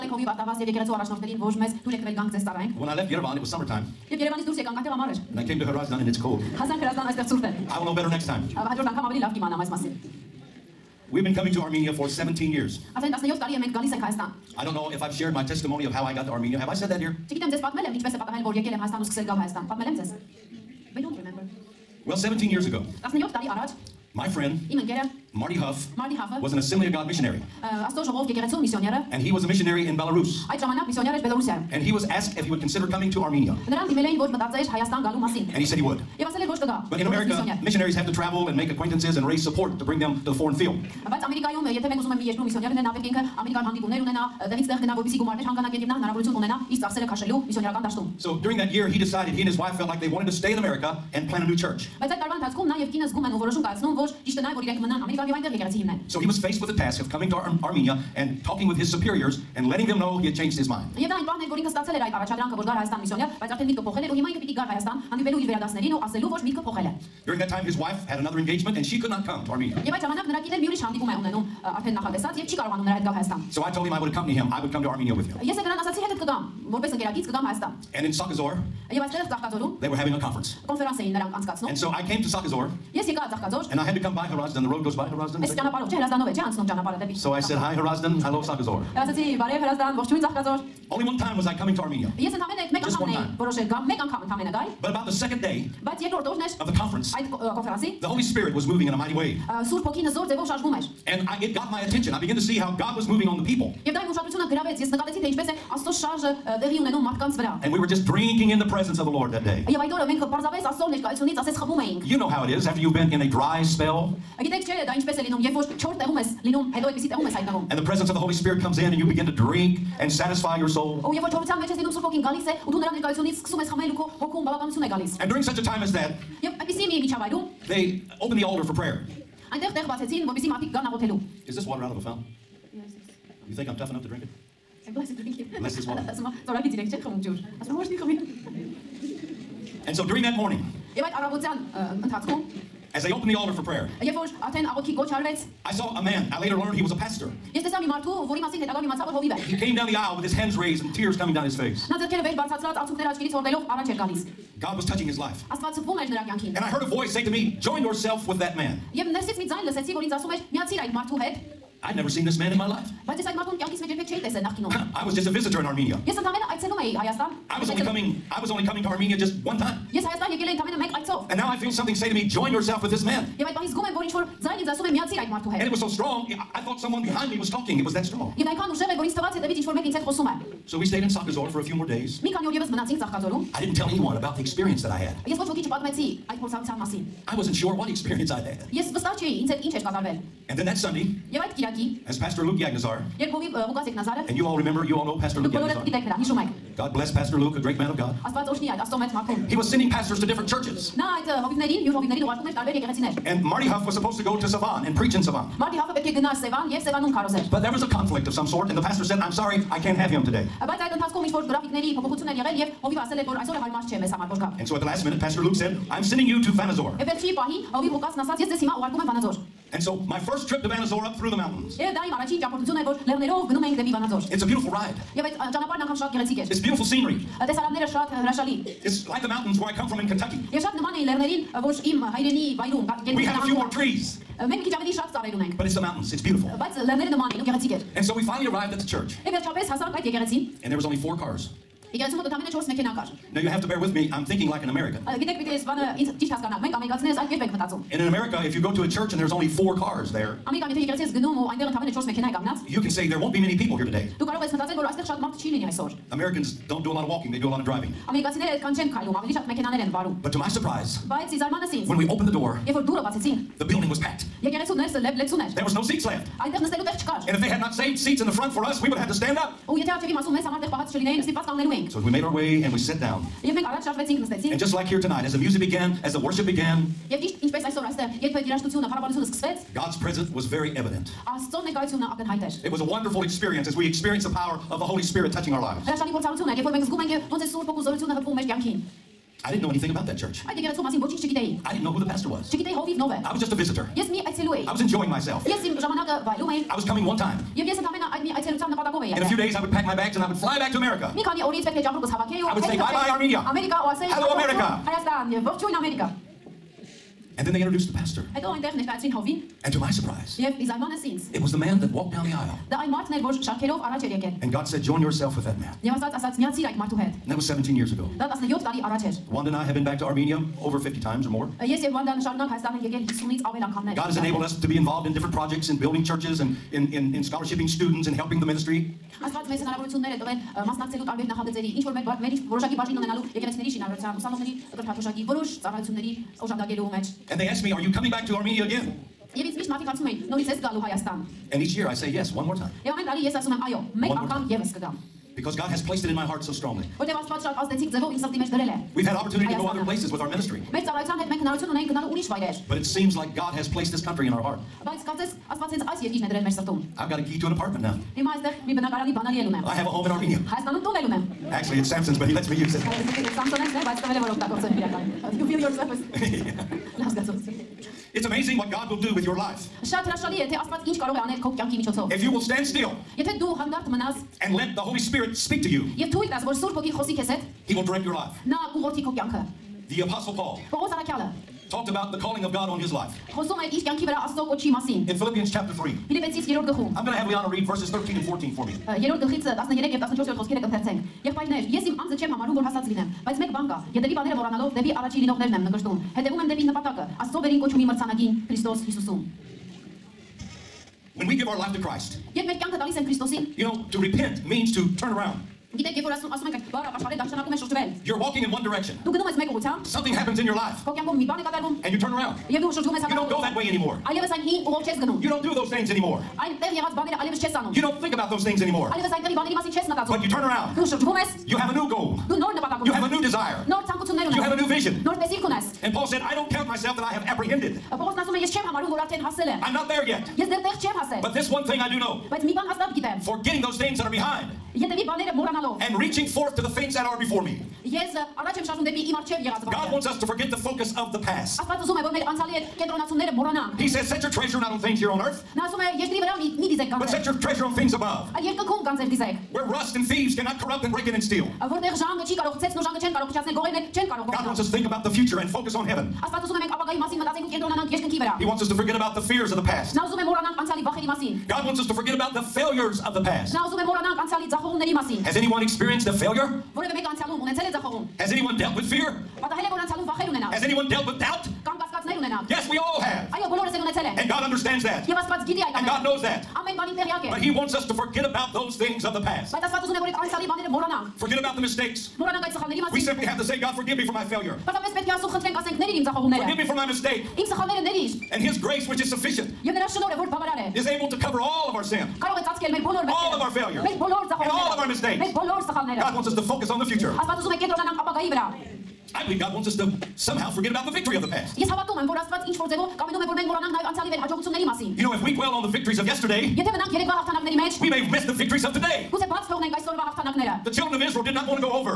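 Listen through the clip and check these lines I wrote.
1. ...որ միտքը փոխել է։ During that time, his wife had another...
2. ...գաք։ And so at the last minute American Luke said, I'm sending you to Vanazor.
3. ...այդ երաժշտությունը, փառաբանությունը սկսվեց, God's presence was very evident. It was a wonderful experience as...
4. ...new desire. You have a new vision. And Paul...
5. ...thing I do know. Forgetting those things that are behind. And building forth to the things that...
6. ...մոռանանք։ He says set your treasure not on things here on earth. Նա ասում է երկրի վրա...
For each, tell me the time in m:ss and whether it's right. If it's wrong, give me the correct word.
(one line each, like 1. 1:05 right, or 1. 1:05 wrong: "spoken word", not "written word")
1. 1:06 right
2. 3:34 wrong: "Pastor", not "American"
3. 4:38 right
4. 7:03 right
5. 7:11 wrong: "reaching", not "building"
6. 7:23 right.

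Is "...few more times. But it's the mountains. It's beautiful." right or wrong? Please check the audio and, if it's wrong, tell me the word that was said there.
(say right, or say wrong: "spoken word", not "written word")
wrong: "trees", not "times".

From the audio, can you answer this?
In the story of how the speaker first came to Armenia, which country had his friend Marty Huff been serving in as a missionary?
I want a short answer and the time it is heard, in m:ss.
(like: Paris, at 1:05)
Belarus, at 0:29.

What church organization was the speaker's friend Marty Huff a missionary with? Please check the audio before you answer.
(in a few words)
Assembly of God.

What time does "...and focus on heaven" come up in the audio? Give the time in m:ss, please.
7:35.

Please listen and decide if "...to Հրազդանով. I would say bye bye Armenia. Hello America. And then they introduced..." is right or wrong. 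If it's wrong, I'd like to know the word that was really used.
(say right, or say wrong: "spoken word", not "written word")
wrong: "America", not "Հրազդանով".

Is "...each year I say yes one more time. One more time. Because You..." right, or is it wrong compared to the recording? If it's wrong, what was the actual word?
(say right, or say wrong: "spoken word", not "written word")
wrong: "God", not "You".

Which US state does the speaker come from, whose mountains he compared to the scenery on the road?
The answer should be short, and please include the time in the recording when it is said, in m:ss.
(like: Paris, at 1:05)
Kentucky, at 3:50.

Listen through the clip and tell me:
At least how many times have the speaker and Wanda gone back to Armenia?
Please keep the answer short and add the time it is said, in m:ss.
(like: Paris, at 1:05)
50, at 5:20.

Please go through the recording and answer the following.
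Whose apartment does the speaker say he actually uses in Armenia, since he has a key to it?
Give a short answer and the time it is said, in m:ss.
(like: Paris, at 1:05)
Samson, at 6:01.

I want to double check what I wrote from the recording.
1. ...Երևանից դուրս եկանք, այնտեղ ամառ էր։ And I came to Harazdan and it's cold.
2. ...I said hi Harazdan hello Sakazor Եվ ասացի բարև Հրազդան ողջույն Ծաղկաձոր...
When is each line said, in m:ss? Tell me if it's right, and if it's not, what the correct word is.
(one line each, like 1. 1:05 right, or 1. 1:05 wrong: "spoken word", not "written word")
1. 0:04 right
2. 1:27 right.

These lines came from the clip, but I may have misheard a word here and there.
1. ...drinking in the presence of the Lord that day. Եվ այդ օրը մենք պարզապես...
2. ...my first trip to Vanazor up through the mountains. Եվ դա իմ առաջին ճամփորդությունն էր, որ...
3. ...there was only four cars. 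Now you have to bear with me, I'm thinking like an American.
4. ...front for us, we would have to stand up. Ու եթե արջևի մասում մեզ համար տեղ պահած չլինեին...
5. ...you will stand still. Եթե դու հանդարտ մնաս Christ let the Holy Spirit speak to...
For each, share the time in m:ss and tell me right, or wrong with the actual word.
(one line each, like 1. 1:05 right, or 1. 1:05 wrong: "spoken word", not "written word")
1. 1:48 right
2. 3:40 right
3. 4:00 right
4. 4:28 right
5. 6:12 wrong: "And", not "Christ".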